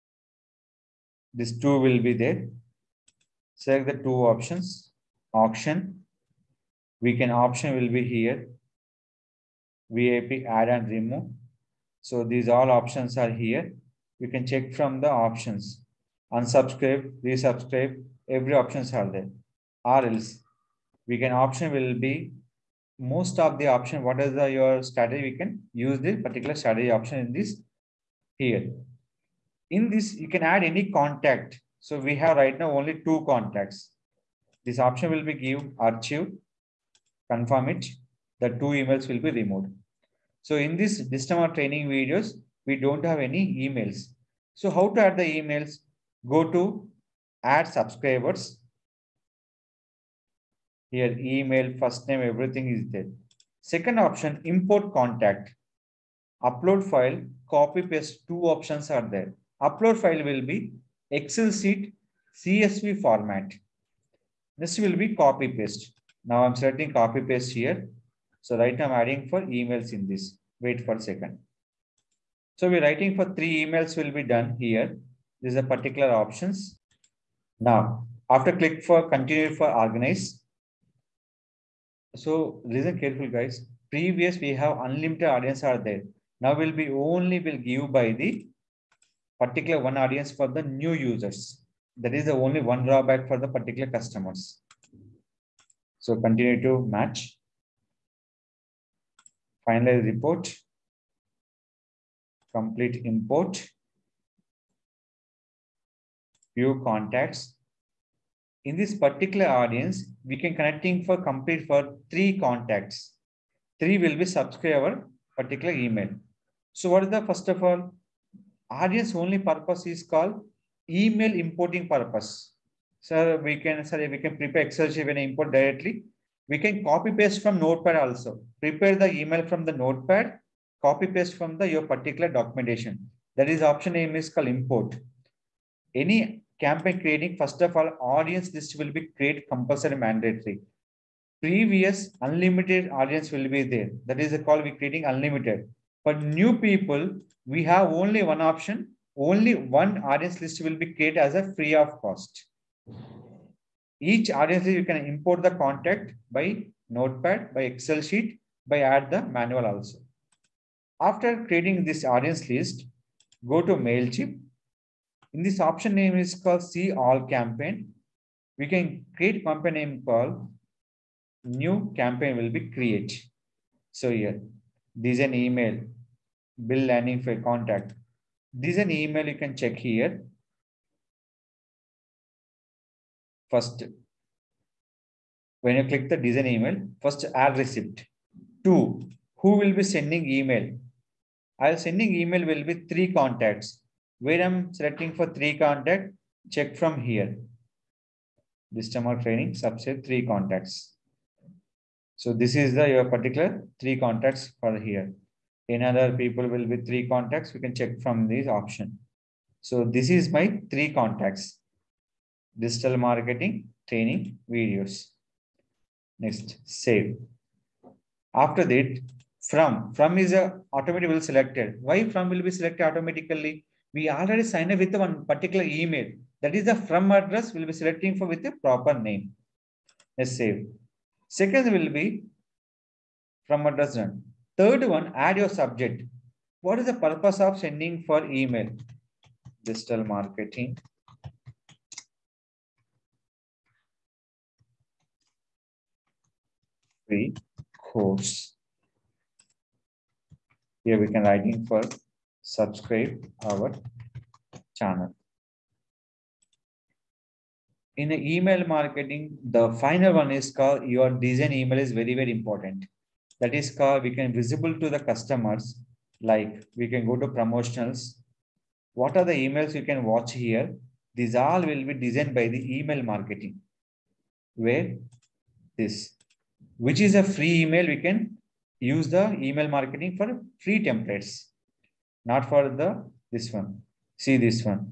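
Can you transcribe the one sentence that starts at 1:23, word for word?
Previous we have unlimited audience are there.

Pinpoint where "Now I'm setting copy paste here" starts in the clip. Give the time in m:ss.
1:06.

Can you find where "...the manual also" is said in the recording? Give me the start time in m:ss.
2:39.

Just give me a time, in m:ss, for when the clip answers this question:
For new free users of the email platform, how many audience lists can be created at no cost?
2:29.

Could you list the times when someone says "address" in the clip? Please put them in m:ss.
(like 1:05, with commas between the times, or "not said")
3:47, 3:53.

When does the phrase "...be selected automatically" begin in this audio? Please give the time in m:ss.
3:42.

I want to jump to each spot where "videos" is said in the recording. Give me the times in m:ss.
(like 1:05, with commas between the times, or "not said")
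0:41, 3:34.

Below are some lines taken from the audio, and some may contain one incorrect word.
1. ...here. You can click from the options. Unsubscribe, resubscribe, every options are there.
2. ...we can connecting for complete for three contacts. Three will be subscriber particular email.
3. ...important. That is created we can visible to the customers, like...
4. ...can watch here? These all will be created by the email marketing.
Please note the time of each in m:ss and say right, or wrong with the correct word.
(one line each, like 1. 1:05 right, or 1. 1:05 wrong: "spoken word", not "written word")
1. 0:13 wrong: "check", not "click"
2. 1:50 right
3. 4:22 wrong: "called", not "created"
4. 4:29 wrong: "designed", not "created".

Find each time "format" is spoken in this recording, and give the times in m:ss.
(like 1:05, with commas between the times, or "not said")
1:03.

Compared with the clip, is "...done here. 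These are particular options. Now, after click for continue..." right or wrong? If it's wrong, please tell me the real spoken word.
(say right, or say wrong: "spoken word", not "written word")
right.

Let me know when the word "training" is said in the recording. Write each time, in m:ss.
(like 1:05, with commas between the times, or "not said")
0:41, 3:19, 3:33.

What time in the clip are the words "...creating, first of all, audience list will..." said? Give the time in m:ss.
2:16.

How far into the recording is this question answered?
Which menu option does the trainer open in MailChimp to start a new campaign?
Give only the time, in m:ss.
2:46.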